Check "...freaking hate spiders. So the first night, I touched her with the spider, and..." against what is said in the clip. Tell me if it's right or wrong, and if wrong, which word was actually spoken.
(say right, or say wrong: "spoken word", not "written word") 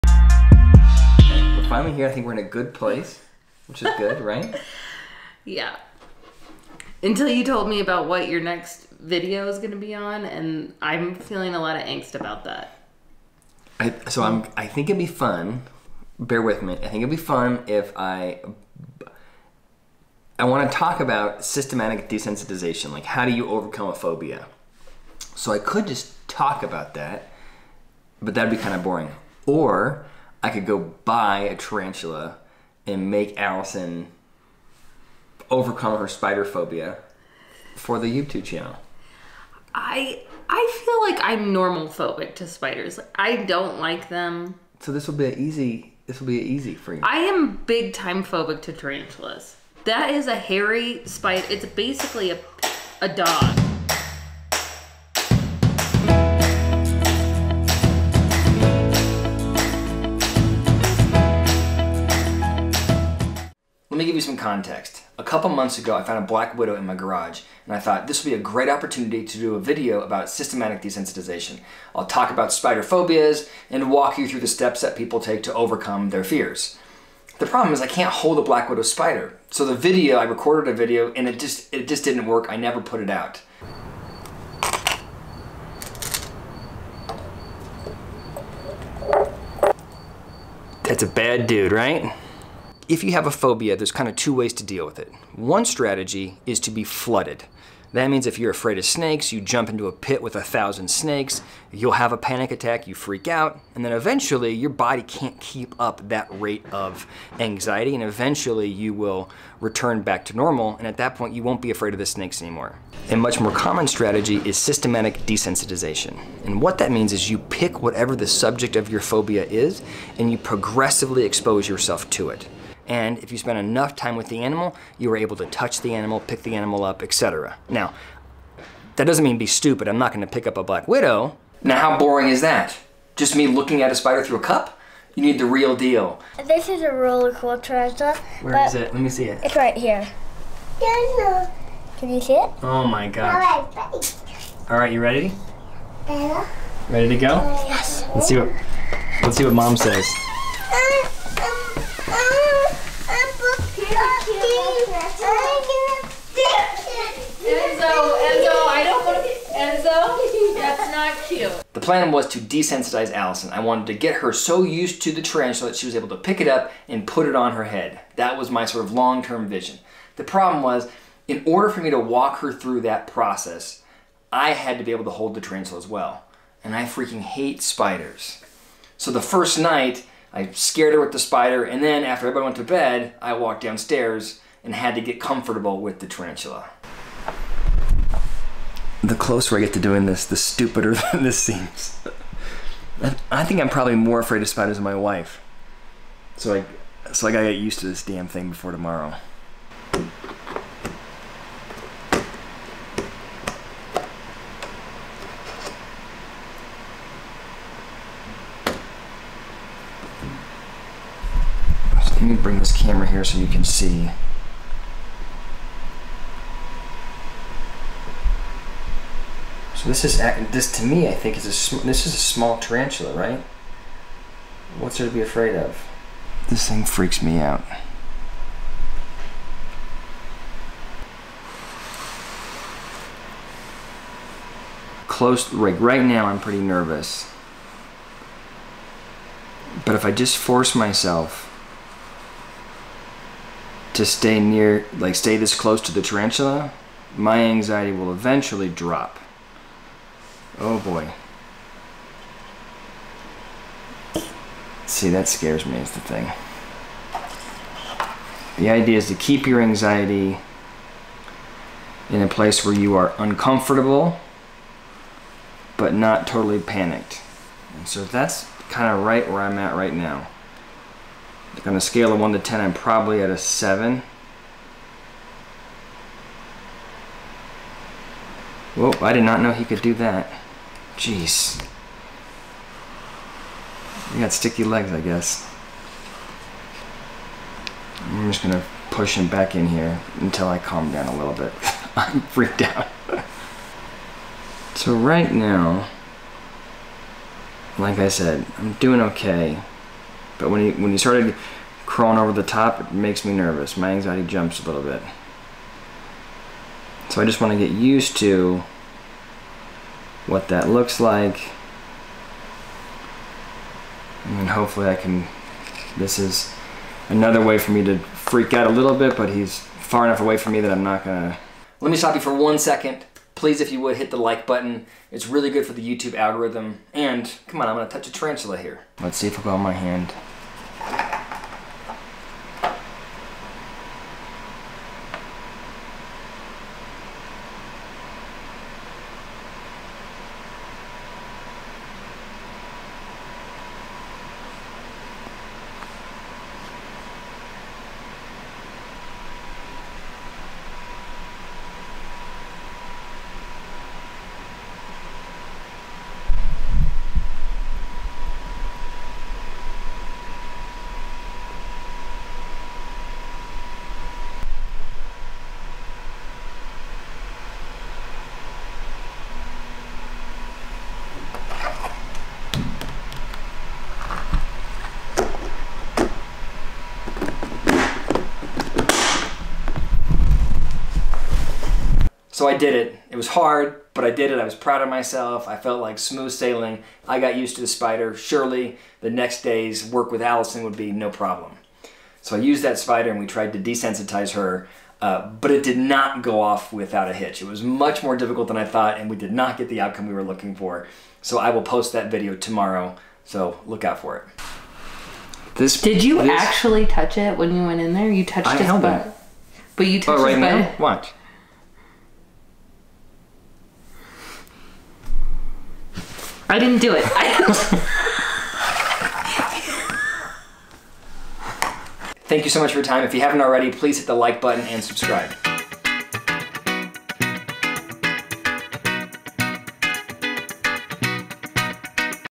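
wrong: "scared", not "touched".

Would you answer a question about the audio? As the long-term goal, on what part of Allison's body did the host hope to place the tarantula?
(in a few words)
her head.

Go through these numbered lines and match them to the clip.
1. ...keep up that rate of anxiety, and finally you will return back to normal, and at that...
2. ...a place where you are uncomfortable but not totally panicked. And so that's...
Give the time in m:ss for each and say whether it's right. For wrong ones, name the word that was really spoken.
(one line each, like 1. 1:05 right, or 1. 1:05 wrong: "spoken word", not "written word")
1. 1:45 wrong: "eventually", not "finally"
2. 4:22 right.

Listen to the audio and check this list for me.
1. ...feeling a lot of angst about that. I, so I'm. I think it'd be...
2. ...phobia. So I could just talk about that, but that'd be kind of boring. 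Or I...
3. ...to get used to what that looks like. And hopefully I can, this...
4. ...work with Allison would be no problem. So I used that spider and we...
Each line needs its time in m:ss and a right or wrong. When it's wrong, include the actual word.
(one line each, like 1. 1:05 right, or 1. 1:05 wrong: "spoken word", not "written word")
1. 0:11 right
2. 0:23 right
3. 5:07 right
4. 6:29 right.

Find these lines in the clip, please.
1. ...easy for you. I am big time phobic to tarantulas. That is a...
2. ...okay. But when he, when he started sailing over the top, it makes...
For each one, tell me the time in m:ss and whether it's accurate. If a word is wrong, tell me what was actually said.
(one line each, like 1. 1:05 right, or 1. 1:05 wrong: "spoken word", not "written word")
1. 0:46 right
2. 4:59 wrong: "crawling", not "sailing".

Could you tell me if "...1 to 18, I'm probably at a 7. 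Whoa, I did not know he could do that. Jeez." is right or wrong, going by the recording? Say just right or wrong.
wrong.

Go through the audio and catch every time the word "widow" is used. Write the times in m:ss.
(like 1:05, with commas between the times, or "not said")
1:06, 1:18, 2:10.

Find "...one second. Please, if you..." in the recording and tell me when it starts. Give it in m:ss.
5:22.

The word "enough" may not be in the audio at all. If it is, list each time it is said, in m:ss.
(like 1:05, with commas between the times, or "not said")
2:03, 5:20.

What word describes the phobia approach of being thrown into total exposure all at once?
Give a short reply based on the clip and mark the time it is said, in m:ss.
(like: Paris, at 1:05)
flooded, at 1:36.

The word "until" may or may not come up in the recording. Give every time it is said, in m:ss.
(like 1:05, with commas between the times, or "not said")
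0:07, 4:50.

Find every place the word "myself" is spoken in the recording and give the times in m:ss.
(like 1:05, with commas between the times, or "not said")
4:00, 6:24.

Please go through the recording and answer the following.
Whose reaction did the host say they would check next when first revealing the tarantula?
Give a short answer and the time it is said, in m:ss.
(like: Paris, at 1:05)
mom, at 2:29.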